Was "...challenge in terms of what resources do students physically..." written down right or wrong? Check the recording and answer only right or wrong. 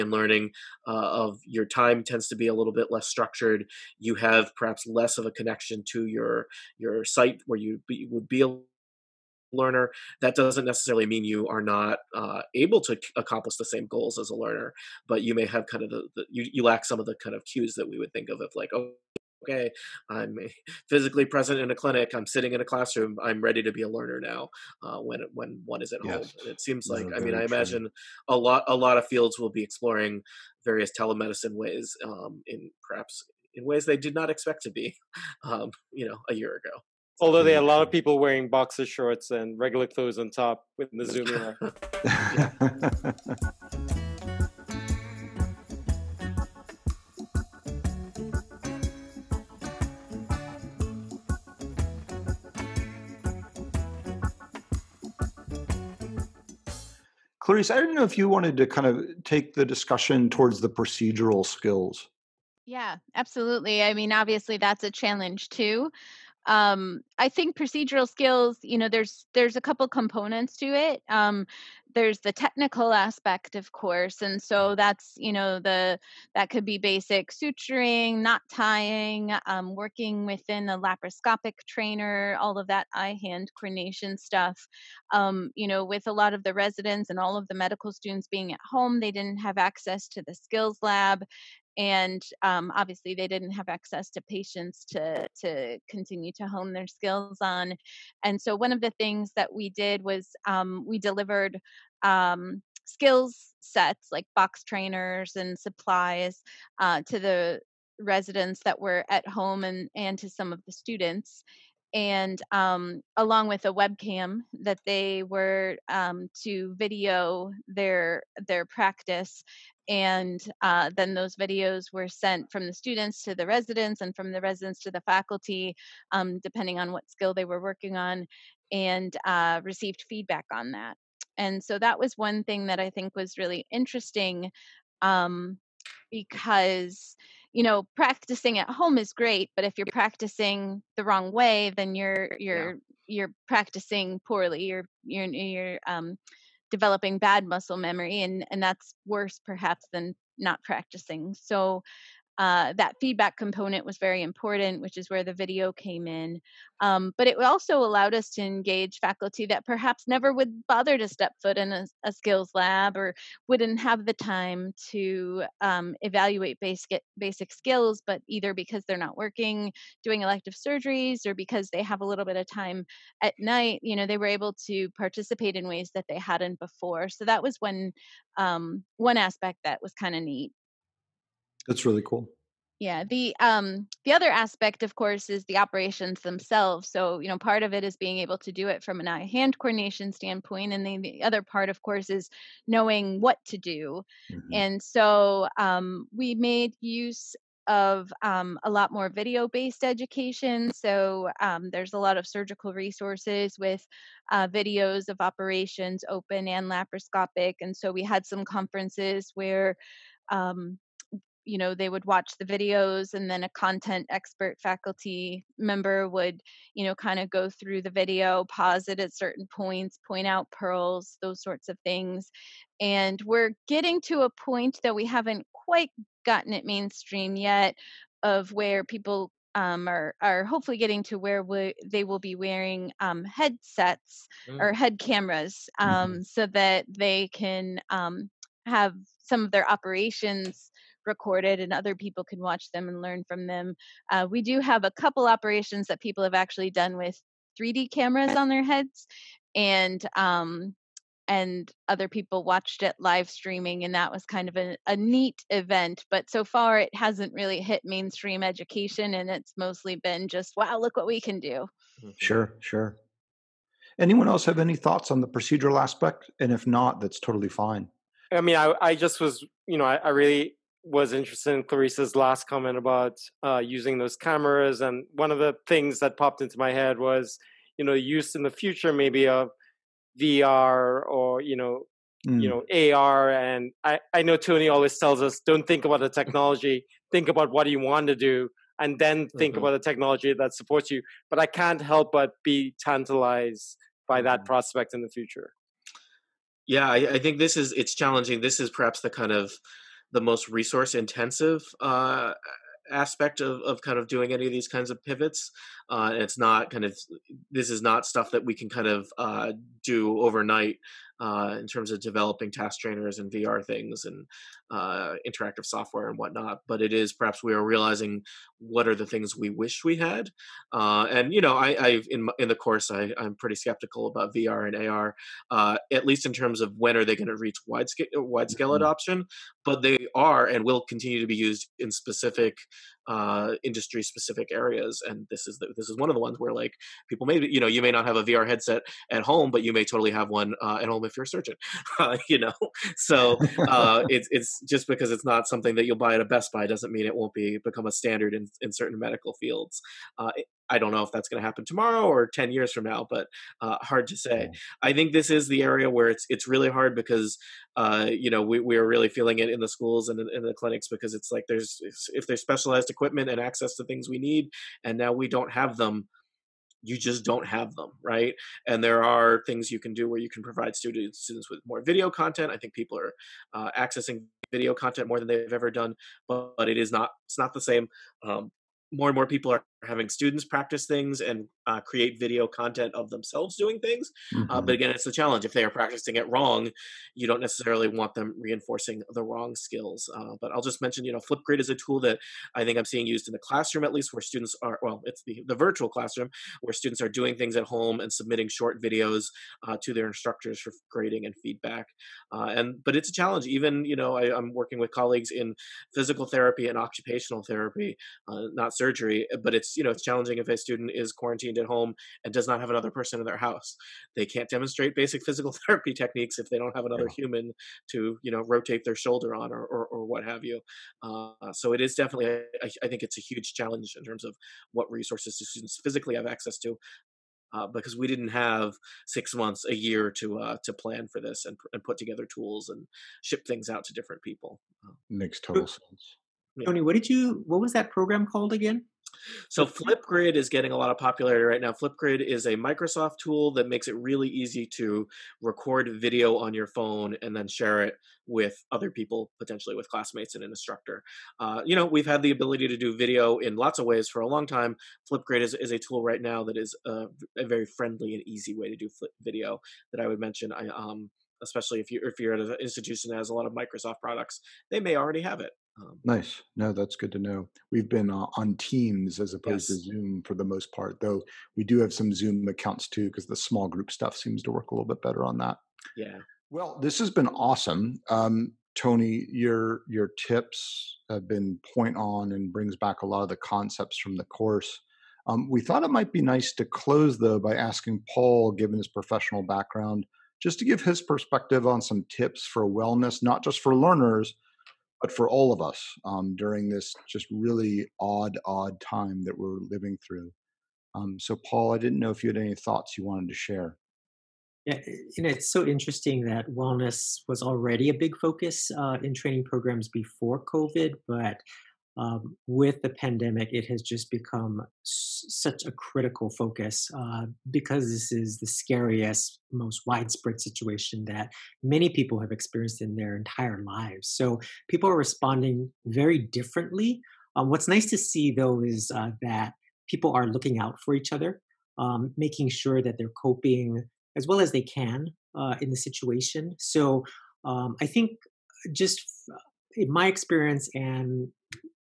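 right.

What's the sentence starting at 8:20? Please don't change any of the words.
Um, so, Paul, I didn't know if you had any thoughts you wanted to share.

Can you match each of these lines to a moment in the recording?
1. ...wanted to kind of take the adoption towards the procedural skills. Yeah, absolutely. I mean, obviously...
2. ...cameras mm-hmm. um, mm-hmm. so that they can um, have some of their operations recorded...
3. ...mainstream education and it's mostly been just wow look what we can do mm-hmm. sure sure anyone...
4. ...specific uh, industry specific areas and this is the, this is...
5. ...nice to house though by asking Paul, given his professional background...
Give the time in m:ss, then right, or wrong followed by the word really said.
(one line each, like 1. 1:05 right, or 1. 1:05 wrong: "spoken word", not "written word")
1. 0:58 wrong: "discussion", not "adoption"
2. 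3:54 right
3. 4:17 right
4. 5:31 right
5. 8:06 wrong: "close", not "house".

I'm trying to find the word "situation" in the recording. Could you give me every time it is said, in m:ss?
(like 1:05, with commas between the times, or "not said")
8:40, 8:55.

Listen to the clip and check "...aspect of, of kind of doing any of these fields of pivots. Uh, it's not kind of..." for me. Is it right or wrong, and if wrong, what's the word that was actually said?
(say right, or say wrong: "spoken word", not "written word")
wrong: "kinds", not "fields".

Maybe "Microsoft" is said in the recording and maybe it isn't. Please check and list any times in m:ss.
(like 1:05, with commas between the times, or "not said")
7:22, 7:43.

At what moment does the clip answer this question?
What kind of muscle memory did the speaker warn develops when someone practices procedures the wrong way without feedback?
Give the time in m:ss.
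2:27.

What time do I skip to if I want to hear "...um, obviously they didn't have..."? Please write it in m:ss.
1:32.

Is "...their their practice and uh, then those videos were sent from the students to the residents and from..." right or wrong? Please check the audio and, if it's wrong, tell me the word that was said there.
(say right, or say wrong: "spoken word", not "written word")
right.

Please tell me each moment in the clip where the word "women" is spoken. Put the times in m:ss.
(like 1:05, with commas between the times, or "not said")
not said.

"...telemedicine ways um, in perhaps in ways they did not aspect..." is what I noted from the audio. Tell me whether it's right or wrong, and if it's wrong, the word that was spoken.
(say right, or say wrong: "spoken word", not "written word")
wrong: "expect", not "aspect".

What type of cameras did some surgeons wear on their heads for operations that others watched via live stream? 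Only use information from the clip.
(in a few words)
3D cameras.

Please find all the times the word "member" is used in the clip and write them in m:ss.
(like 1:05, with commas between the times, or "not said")
3:35.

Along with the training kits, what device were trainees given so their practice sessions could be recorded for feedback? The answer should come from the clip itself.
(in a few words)
webcam.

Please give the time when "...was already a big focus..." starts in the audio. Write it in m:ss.
8:27.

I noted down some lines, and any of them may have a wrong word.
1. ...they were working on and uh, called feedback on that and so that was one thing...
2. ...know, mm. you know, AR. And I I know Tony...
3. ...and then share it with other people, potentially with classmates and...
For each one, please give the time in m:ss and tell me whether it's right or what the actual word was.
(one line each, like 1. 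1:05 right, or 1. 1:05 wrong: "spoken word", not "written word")
1. 2:07 wrong: "received", not "called"
2. 4:41 right
3. 7:27 right.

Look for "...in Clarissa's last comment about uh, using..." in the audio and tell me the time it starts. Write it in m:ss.
4:31.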